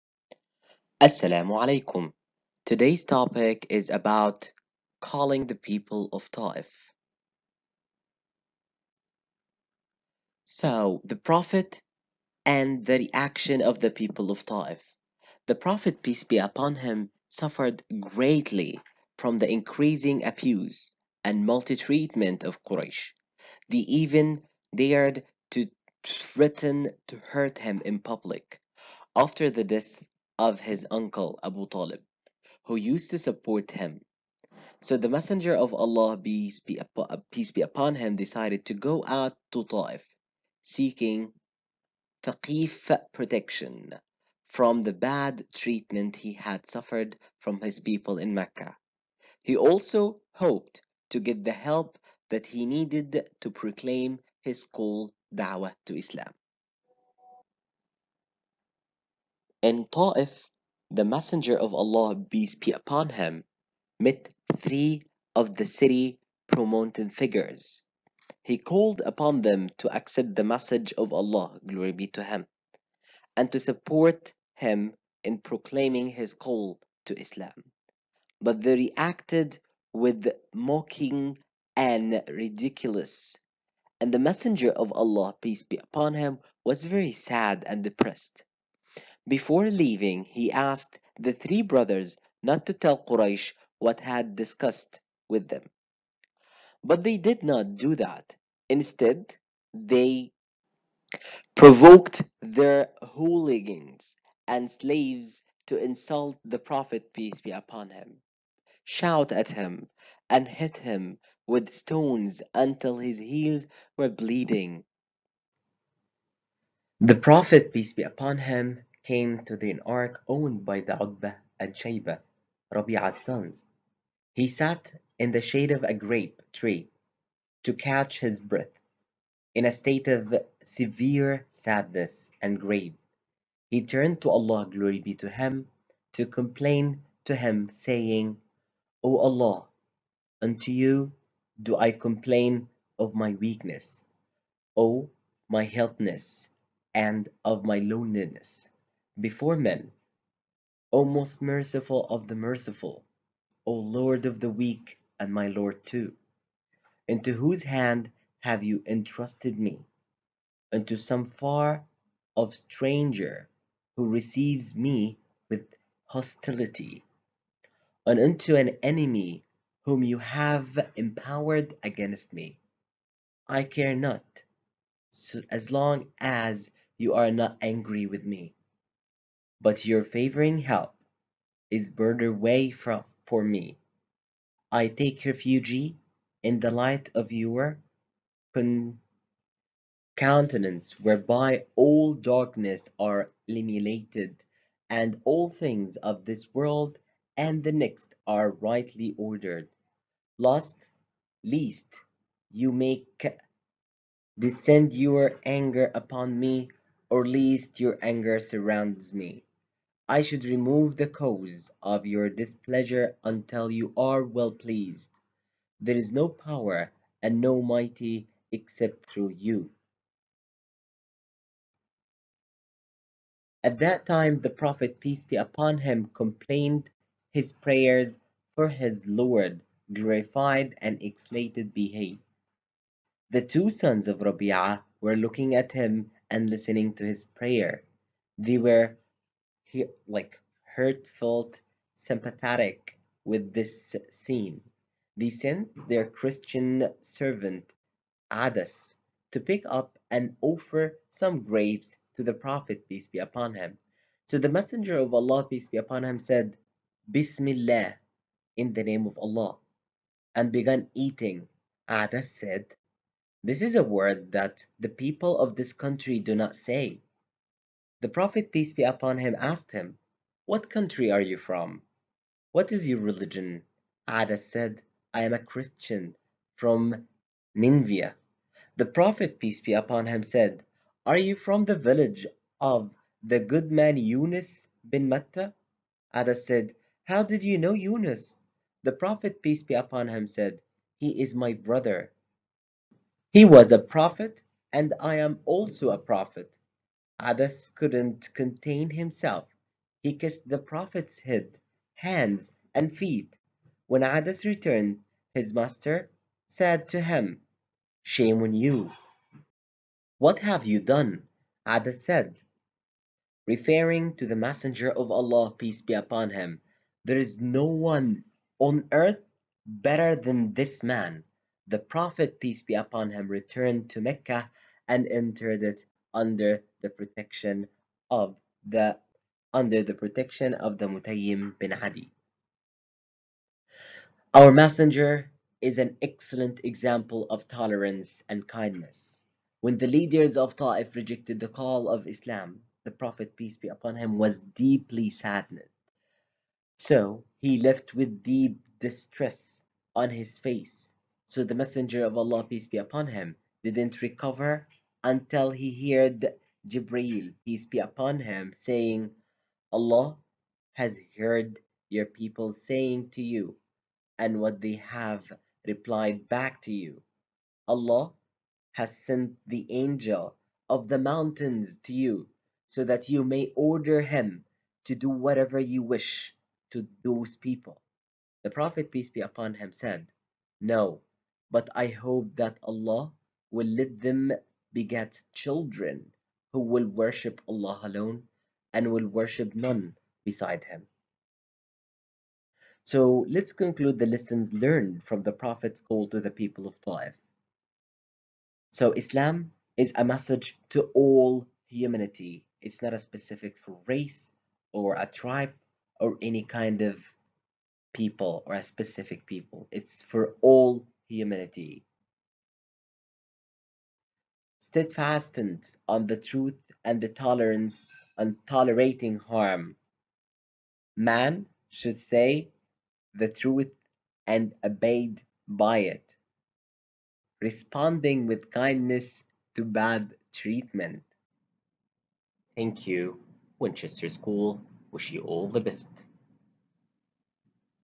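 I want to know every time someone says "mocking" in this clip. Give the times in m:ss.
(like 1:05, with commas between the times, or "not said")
1:20.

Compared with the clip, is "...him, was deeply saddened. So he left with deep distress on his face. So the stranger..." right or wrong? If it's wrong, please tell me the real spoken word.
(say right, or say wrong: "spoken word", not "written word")
wrong: "messenger", not "stranger".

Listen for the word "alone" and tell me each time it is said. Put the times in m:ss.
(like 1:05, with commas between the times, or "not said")
6:27.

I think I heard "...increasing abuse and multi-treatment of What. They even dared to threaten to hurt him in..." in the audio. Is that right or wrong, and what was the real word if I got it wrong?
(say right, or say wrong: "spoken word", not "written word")
wrong: "Quraysh", not "What".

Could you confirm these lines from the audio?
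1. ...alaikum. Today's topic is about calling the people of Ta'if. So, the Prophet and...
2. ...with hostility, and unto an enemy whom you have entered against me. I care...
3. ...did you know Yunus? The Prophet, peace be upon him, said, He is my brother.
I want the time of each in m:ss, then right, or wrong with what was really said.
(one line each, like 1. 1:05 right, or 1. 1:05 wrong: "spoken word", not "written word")
1. 0:01 right
2. 2:45 wrong: "empowered", not "entered"
3. 4:47 right.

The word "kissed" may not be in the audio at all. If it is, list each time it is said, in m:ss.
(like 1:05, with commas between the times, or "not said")
5:00.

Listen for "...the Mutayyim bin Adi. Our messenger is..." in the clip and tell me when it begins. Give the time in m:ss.
5:30.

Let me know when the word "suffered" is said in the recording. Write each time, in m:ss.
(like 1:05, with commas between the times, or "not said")
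0:17, 0:46.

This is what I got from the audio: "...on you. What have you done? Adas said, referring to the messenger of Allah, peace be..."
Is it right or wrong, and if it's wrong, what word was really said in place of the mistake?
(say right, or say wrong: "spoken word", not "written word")
right.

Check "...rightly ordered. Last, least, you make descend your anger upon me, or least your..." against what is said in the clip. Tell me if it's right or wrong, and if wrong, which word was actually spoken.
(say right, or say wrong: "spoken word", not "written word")
right.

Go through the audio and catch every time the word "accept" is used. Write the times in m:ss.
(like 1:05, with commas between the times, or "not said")
1:09.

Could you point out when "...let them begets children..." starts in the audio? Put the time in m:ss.
6:23.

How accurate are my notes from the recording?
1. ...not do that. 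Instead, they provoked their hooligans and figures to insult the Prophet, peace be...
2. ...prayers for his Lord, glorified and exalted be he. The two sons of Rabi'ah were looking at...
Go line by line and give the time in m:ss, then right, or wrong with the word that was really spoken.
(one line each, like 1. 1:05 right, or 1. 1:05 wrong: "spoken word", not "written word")
1. 1:37 wrong: "slaves", not "figures"
2. 3:47 right.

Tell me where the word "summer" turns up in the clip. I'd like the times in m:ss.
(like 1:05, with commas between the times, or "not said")
not said.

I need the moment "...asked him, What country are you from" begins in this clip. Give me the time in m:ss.
4:29.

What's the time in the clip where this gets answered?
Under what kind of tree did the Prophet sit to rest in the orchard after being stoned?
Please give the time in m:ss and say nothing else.
2:05.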